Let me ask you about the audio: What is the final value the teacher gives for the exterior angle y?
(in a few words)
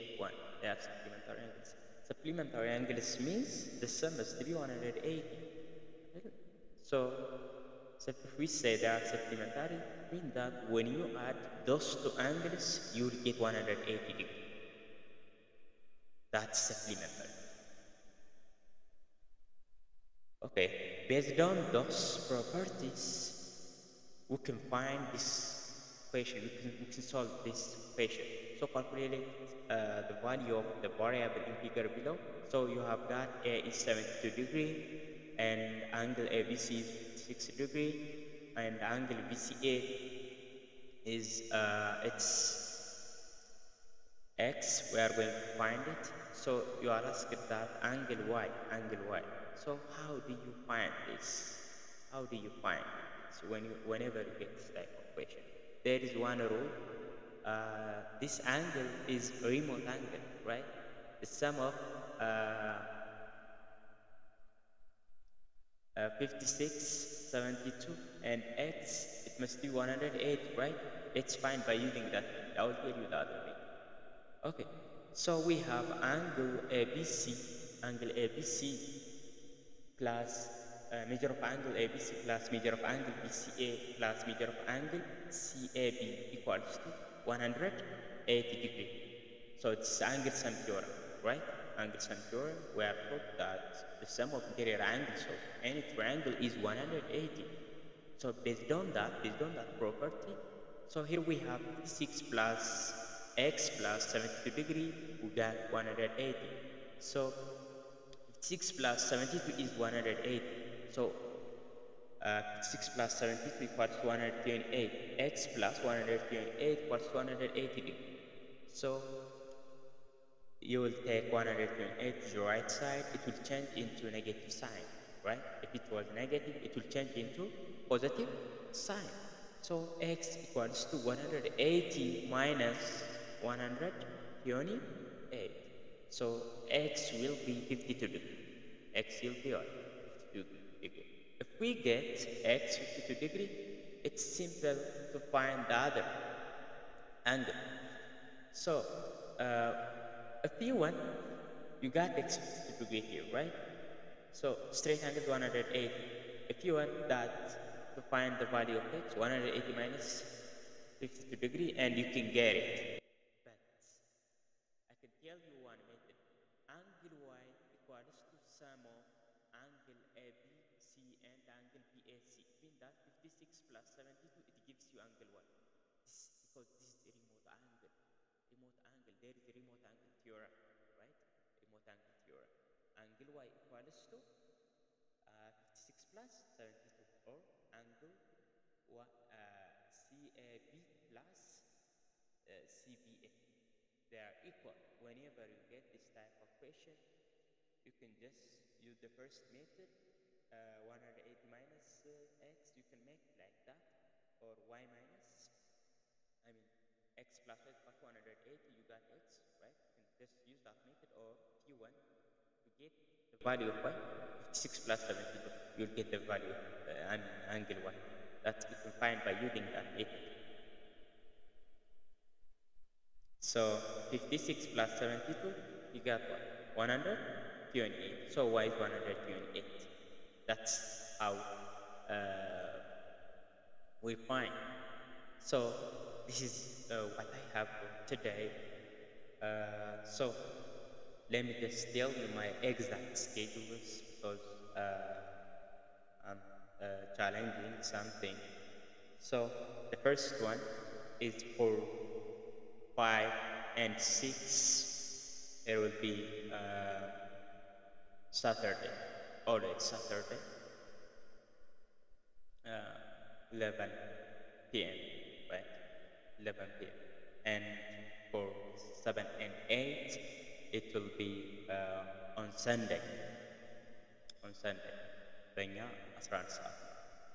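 128.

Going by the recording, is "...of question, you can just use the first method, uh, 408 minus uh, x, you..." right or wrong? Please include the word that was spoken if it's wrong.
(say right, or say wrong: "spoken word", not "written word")
wrong: "108", not "408".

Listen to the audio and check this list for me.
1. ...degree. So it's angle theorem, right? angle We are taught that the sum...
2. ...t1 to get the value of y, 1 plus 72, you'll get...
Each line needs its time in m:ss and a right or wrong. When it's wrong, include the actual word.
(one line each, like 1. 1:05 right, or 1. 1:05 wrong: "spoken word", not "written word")
1. 1:28 right
2. 3:31 wrong: "6", not "1".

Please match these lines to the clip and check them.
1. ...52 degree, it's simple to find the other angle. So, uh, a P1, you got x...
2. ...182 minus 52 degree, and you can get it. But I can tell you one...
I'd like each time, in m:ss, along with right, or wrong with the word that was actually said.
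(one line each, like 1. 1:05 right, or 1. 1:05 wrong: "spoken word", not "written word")
1. 2:22 right
2. 2:39 wrong: "180", not "182".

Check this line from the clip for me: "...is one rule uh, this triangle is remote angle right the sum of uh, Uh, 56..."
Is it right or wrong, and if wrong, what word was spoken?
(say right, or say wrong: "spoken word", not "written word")
wrong: "angle", not "triangle".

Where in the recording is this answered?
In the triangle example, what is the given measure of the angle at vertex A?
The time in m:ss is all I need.
0:33.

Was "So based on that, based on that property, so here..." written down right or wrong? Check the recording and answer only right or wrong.
right.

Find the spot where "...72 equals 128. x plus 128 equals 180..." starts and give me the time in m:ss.
1:53.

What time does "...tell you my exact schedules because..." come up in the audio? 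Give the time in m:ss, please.
4:01.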